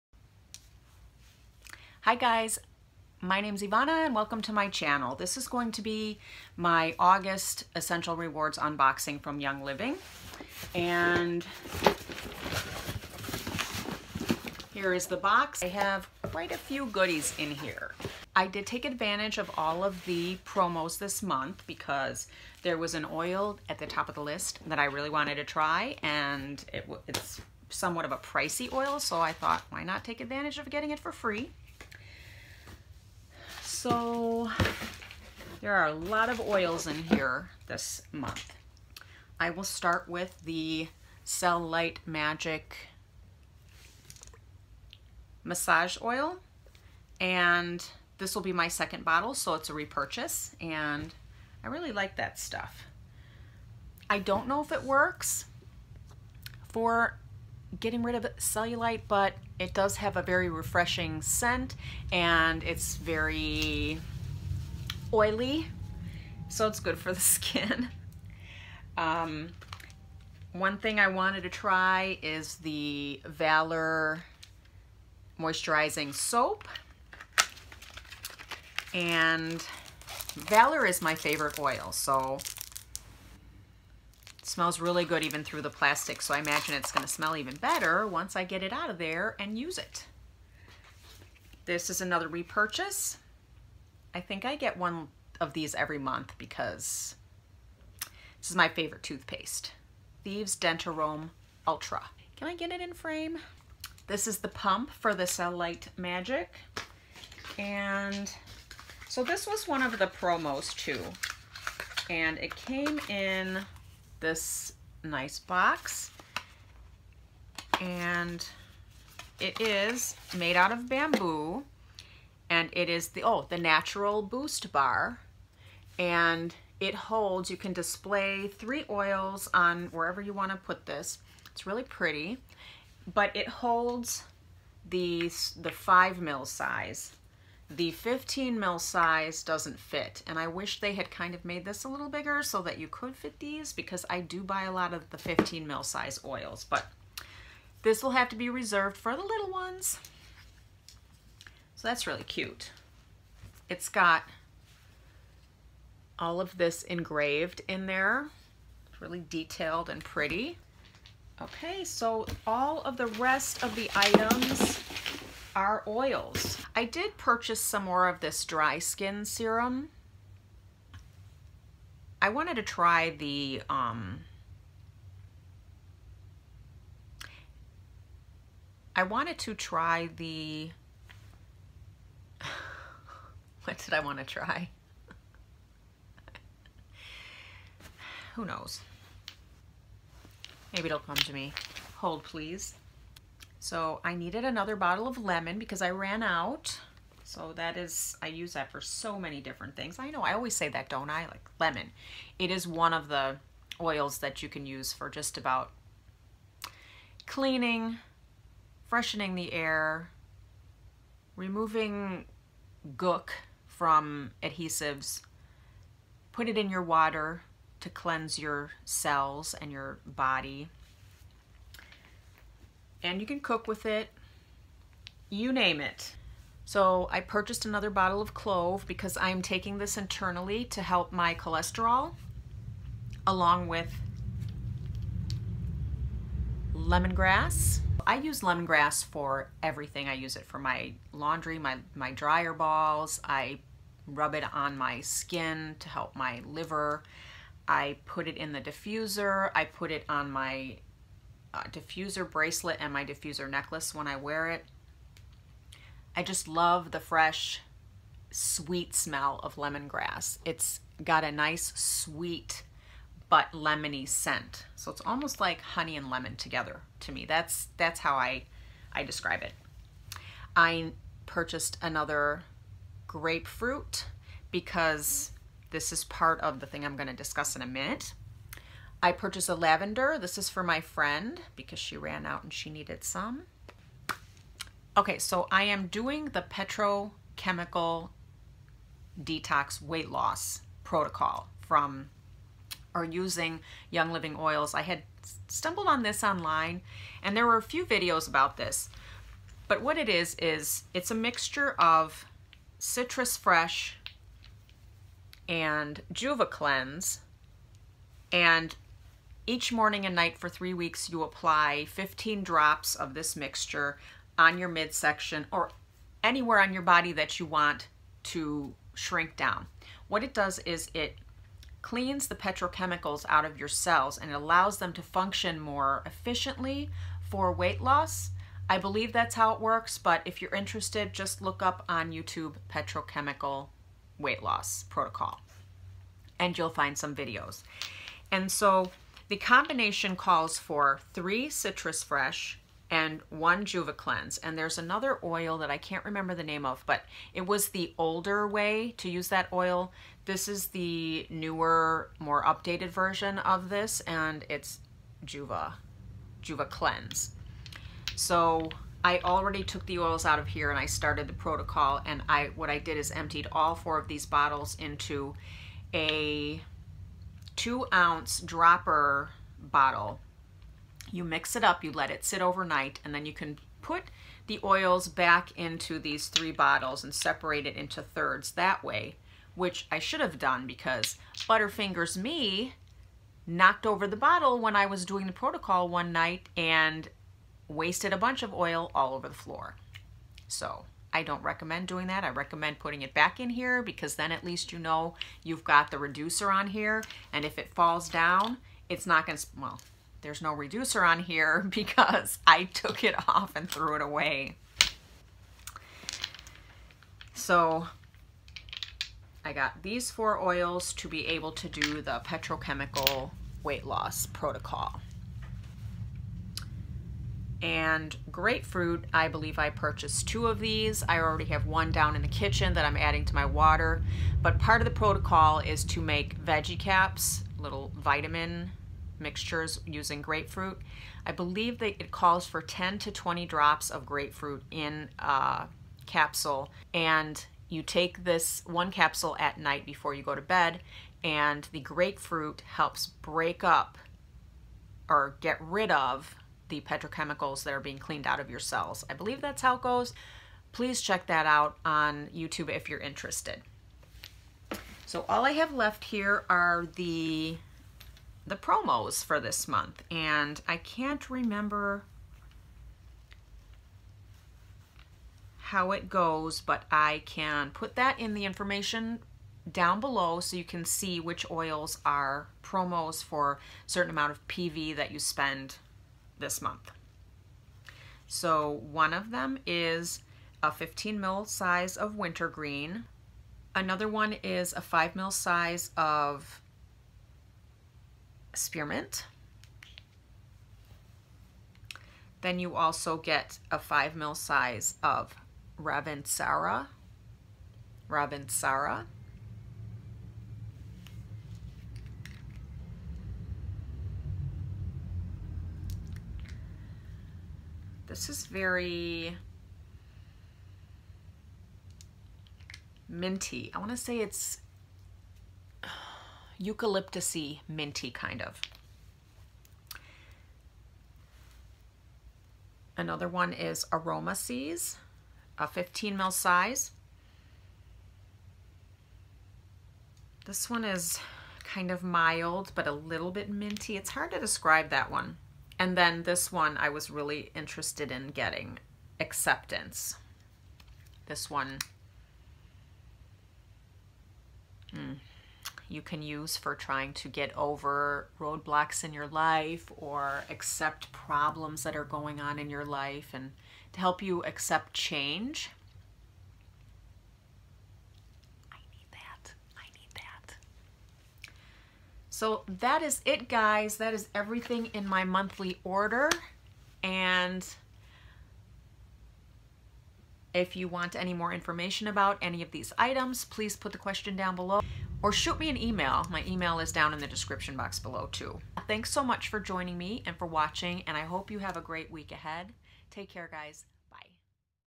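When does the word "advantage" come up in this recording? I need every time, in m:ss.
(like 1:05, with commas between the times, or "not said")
0:18, 0:30.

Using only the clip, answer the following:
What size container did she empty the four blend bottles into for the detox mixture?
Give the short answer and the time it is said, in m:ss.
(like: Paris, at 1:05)
two ounce dropper bottle, at 6:07.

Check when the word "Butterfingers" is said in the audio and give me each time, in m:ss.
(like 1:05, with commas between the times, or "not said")
6:21.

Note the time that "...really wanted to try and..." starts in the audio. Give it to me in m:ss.
0:24.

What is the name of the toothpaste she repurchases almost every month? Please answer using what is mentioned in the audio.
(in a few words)
Thieves Dentarome Ultra.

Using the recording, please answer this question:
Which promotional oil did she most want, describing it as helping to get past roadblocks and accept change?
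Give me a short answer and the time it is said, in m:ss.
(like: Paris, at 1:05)
Acceptance, at 8:59.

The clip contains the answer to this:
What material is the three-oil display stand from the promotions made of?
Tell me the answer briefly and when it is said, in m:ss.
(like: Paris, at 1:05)
bamboo, at 2:00.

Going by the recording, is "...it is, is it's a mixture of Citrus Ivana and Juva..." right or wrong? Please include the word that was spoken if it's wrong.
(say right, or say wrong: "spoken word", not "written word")
wrong: "Fresh", not "Ivana".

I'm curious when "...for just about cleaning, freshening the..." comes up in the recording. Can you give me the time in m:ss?
3:24.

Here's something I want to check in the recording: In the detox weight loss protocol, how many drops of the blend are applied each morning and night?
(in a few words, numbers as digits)
15.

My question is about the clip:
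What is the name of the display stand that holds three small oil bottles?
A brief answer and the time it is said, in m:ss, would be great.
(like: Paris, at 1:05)
natural boost bar, at 2:03.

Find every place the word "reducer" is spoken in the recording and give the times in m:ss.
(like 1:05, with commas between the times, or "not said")
6:35, 6:40.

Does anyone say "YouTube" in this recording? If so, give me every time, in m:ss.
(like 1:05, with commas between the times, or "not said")
5:32, 7:32.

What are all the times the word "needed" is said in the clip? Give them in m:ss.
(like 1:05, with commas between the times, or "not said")
3:14, 4:42.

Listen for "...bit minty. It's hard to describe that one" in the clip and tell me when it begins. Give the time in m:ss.
8:53.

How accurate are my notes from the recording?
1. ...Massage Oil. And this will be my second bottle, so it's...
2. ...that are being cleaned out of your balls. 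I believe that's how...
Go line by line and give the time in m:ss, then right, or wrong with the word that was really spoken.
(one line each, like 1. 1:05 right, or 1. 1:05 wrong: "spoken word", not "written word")
1. 0:45 right
2. 7:27 wrong: "cells", not "balls".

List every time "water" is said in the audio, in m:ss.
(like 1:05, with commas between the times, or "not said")
3:36, 7:03.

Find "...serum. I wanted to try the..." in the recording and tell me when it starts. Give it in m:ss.
2:49.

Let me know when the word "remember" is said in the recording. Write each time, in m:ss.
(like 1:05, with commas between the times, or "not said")
5:46, 7:41.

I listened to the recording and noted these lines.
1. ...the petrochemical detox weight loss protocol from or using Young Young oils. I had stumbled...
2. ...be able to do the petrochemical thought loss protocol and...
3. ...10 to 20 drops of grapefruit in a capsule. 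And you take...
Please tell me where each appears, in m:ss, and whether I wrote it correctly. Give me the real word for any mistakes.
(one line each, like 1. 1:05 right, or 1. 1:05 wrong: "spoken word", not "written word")
1. 4:46 wrong: "Living", not "Young"
2. 6:51 wrong: "weight", not "thought"
3. 7:12 right.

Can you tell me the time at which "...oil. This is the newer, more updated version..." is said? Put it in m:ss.
5:49.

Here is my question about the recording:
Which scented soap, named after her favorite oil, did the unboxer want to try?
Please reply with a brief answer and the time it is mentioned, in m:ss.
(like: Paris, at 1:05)
Valor Moisturizing Soap, at 1:13.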